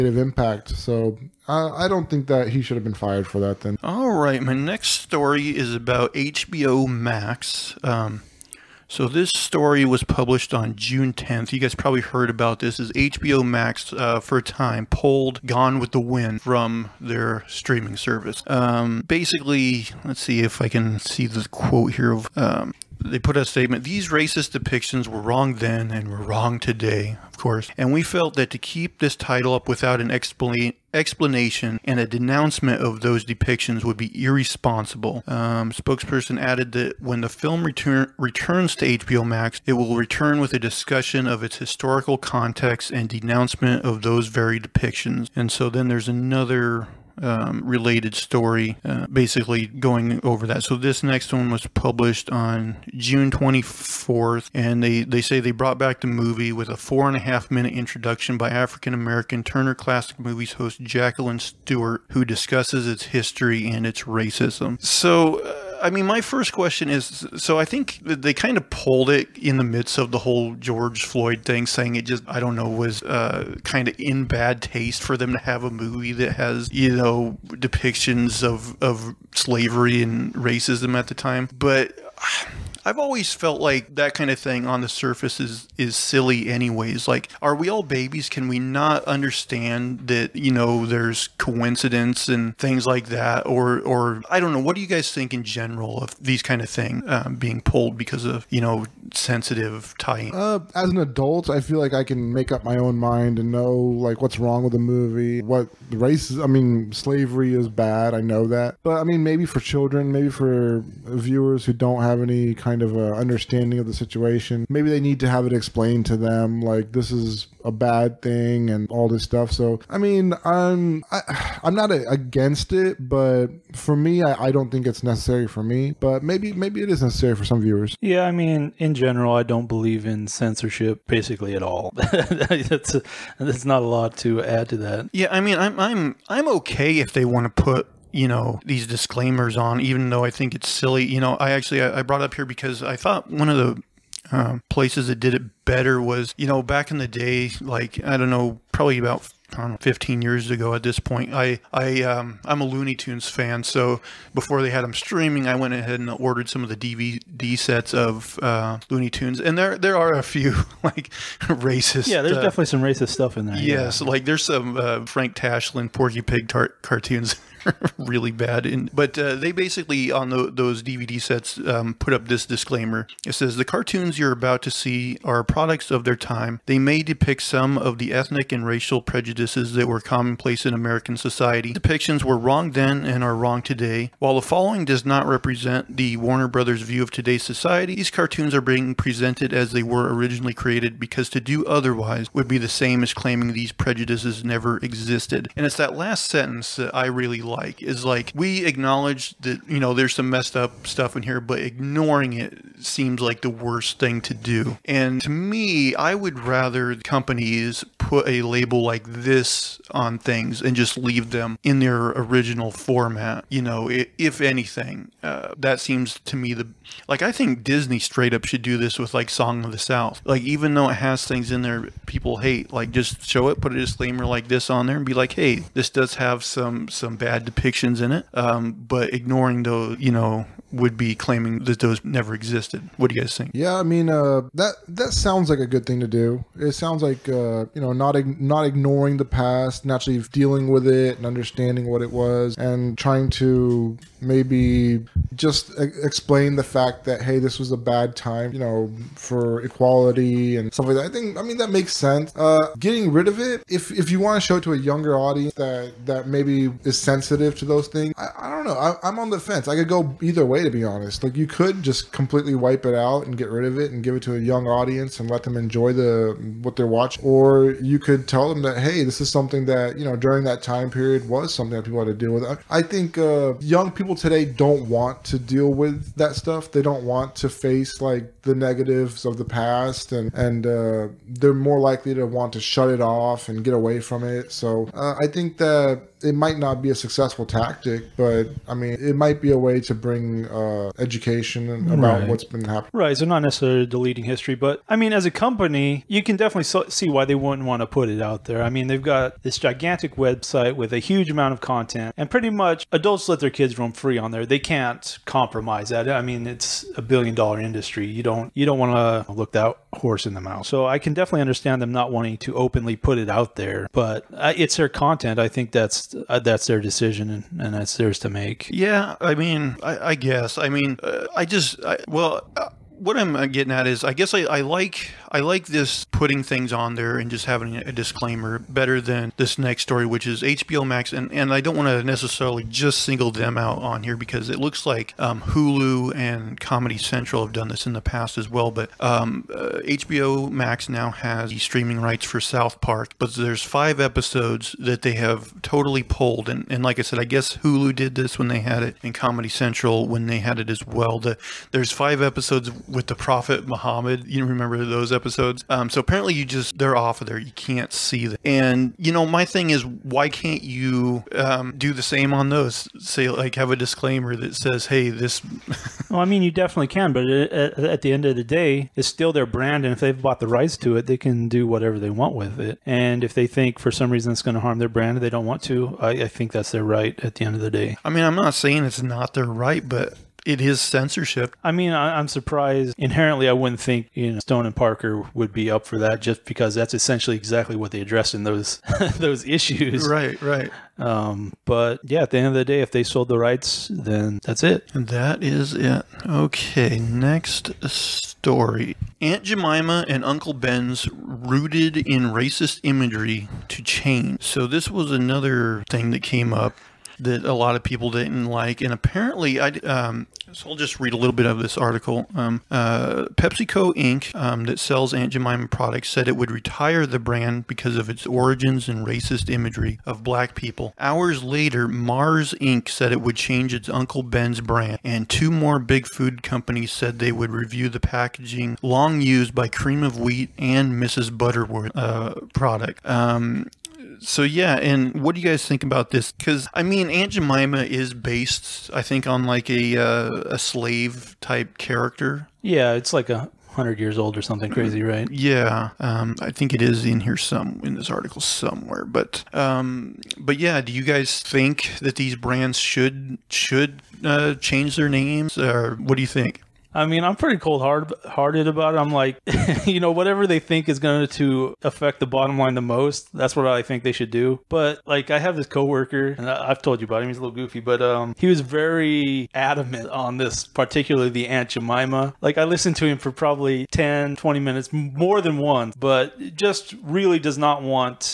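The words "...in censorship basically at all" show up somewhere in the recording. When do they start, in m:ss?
2:10.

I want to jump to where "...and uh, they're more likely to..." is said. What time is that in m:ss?
4:40.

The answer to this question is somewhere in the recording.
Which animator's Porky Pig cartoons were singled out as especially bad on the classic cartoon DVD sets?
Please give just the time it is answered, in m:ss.
2:45.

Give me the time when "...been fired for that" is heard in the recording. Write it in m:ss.
0:02.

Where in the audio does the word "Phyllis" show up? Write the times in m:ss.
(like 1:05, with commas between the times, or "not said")
not said.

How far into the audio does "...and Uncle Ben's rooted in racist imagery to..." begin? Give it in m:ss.
6:40.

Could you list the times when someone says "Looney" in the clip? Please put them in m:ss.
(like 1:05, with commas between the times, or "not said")
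2:32, 2:38.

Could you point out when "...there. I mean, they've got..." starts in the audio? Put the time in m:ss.
4:58.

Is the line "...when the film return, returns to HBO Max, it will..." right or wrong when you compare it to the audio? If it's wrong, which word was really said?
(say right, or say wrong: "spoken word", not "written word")
right.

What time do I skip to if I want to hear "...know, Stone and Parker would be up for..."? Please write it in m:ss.
6:24.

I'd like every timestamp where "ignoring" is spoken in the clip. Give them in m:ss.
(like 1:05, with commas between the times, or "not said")
3:21, 3:49, 3:58.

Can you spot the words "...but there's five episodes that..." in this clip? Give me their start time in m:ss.
5:43.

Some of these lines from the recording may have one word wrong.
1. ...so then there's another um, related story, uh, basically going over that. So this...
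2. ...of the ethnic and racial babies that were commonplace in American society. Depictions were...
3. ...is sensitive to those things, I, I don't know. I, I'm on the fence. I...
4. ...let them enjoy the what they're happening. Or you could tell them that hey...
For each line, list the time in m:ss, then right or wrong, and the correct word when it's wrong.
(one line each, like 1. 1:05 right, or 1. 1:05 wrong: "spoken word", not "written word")
1. 0:45 right
2. 2:57 wrong: "prejudices", not "babies"
3. 4:16 right
4. 4:25 wrong: "watching", not "happening".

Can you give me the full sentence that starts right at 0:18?
Um, basically, let's see if I can see the quote here.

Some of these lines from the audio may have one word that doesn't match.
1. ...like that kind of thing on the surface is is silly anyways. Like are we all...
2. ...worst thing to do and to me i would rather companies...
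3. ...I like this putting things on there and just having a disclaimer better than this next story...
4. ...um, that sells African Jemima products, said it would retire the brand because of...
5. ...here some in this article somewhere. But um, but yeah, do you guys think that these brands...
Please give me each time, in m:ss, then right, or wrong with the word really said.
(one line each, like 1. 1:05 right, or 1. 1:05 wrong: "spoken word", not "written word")
1. 1:23 right
2. 3:23 right
3. 5:25 right
4. 6:54 wrong: "Aunt", not "African"
5. 7:27 right.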